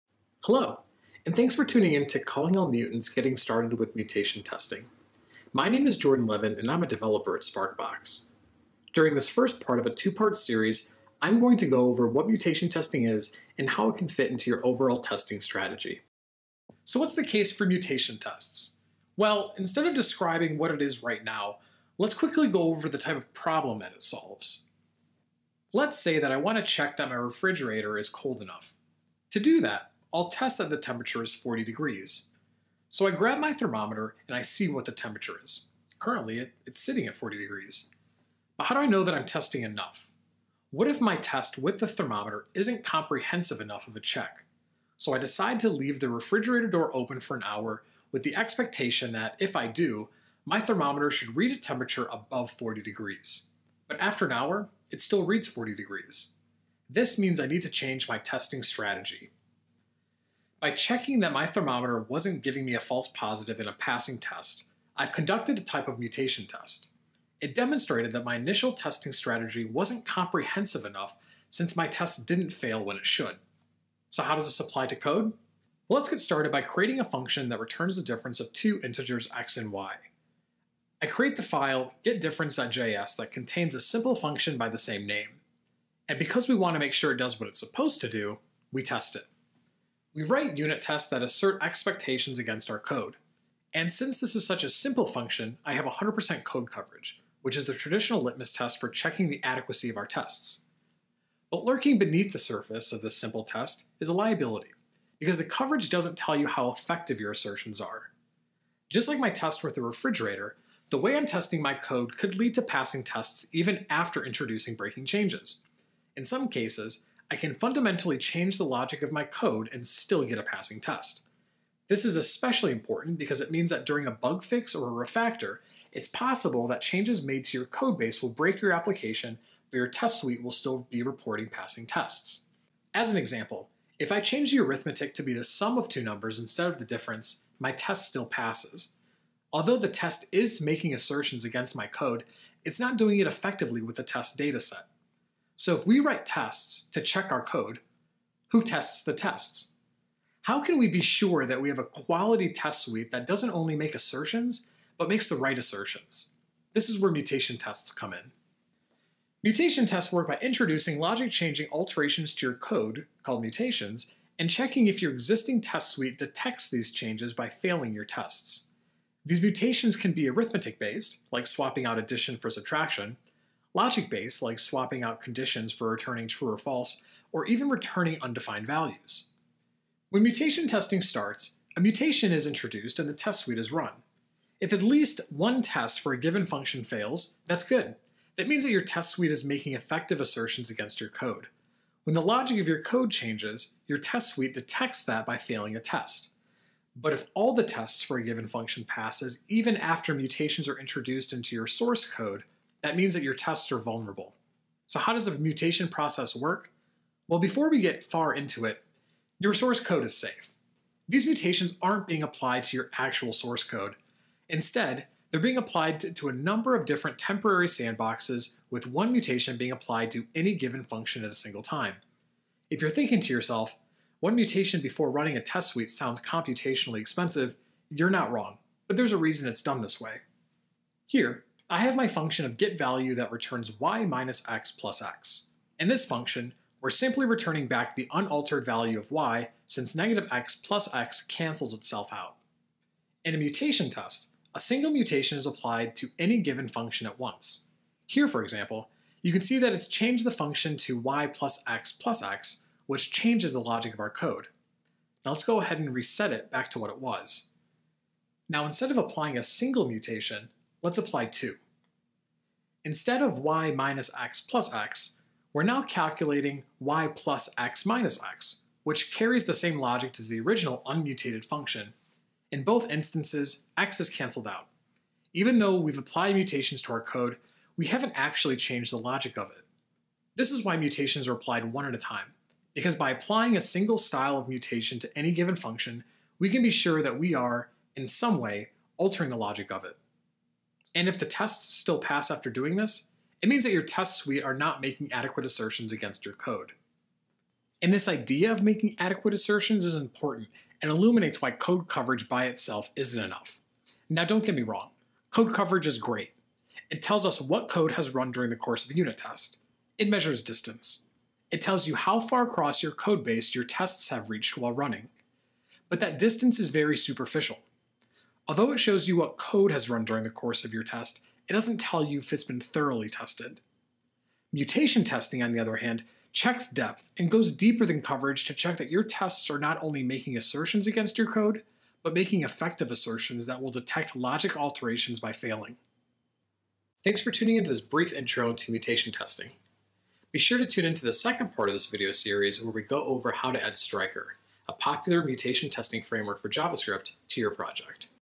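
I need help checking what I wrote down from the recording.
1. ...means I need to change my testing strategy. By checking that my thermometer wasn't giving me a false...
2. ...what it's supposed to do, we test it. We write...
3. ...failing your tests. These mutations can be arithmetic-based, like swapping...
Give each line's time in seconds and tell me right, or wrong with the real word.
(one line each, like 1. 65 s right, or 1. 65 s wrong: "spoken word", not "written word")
1. 57 s right
2. 87 s right
3. 167 s right.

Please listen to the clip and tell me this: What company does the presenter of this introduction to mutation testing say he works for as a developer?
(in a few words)
Sparkbox.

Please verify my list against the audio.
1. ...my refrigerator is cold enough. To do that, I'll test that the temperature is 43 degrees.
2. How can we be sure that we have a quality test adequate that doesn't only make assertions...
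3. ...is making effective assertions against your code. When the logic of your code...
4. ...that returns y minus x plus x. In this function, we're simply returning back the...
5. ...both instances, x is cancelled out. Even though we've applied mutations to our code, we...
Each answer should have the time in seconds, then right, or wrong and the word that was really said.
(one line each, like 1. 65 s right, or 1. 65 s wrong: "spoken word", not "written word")
1. 27 s wrong: "40", not "43"
2. 150 s wrong: "suite", not "adequate"
3. 189 s right
4. 233 s right
5. 272 s right.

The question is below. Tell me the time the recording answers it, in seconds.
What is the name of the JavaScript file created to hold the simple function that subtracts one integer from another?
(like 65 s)
82 s.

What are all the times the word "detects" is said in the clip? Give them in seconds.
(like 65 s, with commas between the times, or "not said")
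166 s, 194 s, 333 s.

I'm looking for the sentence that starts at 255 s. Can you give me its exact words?
Now let's go ahead and reset it back to what it was.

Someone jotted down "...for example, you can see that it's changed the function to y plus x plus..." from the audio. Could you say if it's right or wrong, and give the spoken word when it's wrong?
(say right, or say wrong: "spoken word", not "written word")
right.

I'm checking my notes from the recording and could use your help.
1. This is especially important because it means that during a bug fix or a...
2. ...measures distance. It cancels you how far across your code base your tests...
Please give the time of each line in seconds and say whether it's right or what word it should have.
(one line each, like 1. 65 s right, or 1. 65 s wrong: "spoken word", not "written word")
1. 121 s right
2. 310 s wrong: "tells", not "cancels".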